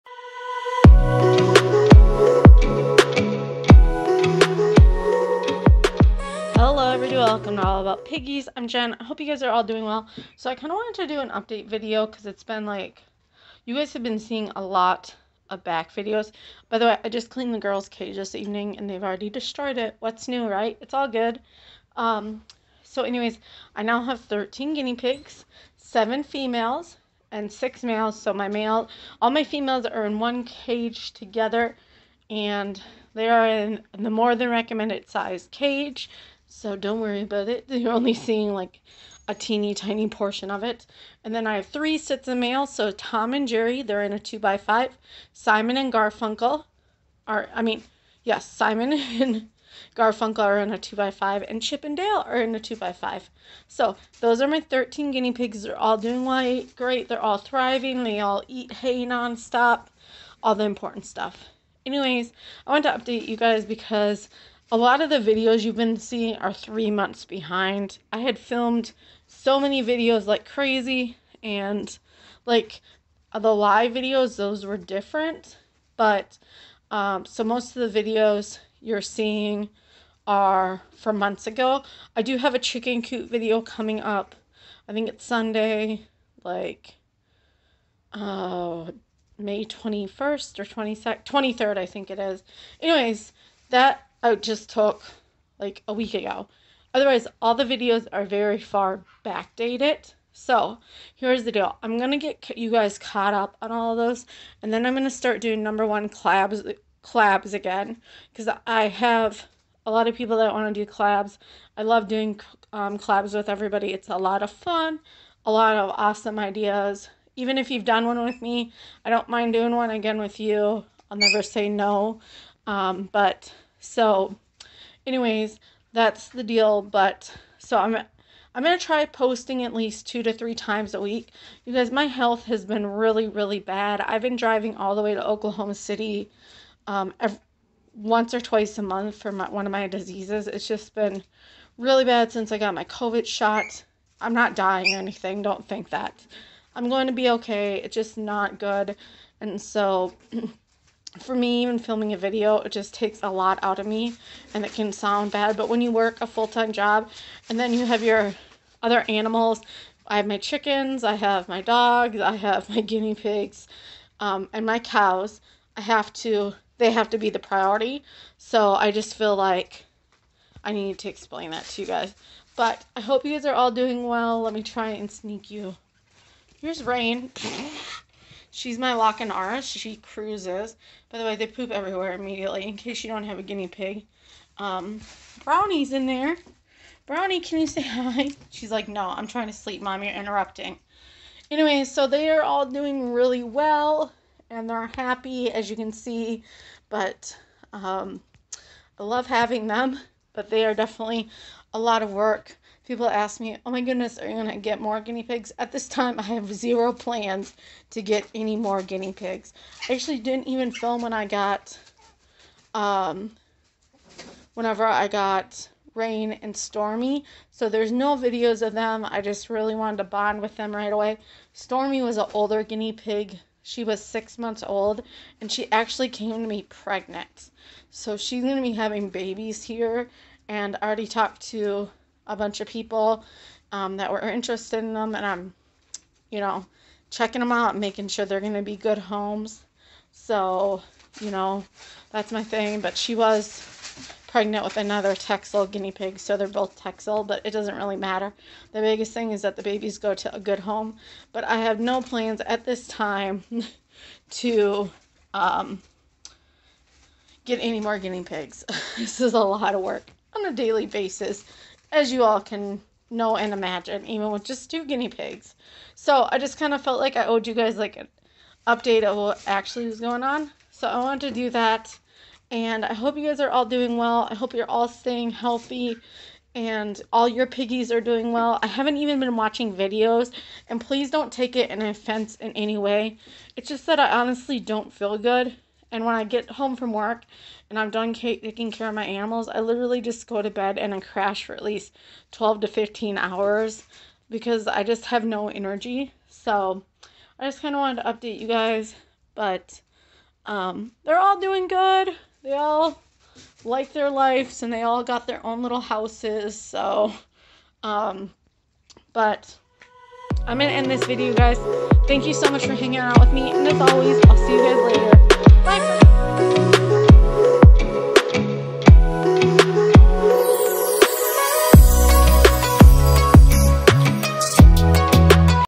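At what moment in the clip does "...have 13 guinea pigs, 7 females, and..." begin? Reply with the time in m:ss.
0:24.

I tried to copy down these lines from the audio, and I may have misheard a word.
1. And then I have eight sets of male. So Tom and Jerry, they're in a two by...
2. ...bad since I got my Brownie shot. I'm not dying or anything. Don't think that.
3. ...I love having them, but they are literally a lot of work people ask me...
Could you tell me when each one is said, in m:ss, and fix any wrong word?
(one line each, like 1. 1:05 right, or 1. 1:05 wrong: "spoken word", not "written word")
1. 0:41 wrong: "three", not "eight"
2. 2:22 wrong: "COVID", not "Brownie"
3. 3:18 wrong: "definitely", not "literally".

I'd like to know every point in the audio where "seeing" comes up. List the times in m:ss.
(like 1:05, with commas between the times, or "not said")
0:14, 0:38, 1:05, 1:19.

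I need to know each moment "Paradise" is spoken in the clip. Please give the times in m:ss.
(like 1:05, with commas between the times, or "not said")
not said.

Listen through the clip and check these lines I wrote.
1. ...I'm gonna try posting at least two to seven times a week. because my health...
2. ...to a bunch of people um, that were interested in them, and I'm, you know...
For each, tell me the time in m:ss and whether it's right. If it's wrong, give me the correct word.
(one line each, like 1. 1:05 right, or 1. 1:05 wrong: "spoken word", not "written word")
1. 2:08 wrong: "three", not "seven"
2. 3:51 right.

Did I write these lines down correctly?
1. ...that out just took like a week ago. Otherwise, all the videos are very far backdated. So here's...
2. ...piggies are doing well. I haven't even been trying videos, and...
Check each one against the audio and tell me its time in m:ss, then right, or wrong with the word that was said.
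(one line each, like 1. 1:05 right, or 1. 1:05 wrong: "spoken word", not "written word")
1. 1:33 right
2. 4:37 wrong: "watching", not "trying".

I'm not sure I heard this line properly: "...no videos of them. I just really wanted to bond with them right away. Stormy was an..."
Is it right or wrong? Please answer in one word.
right.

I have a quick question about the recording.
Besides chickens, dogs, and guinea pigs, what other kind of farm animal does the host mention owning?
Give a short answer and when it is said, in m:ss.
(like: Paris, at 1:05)
Cows, at 2:44.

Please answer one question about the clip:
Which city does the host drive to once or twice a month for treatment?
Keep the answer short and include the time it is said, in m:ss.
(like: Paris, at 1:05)
Oklahoma City, at 2:15.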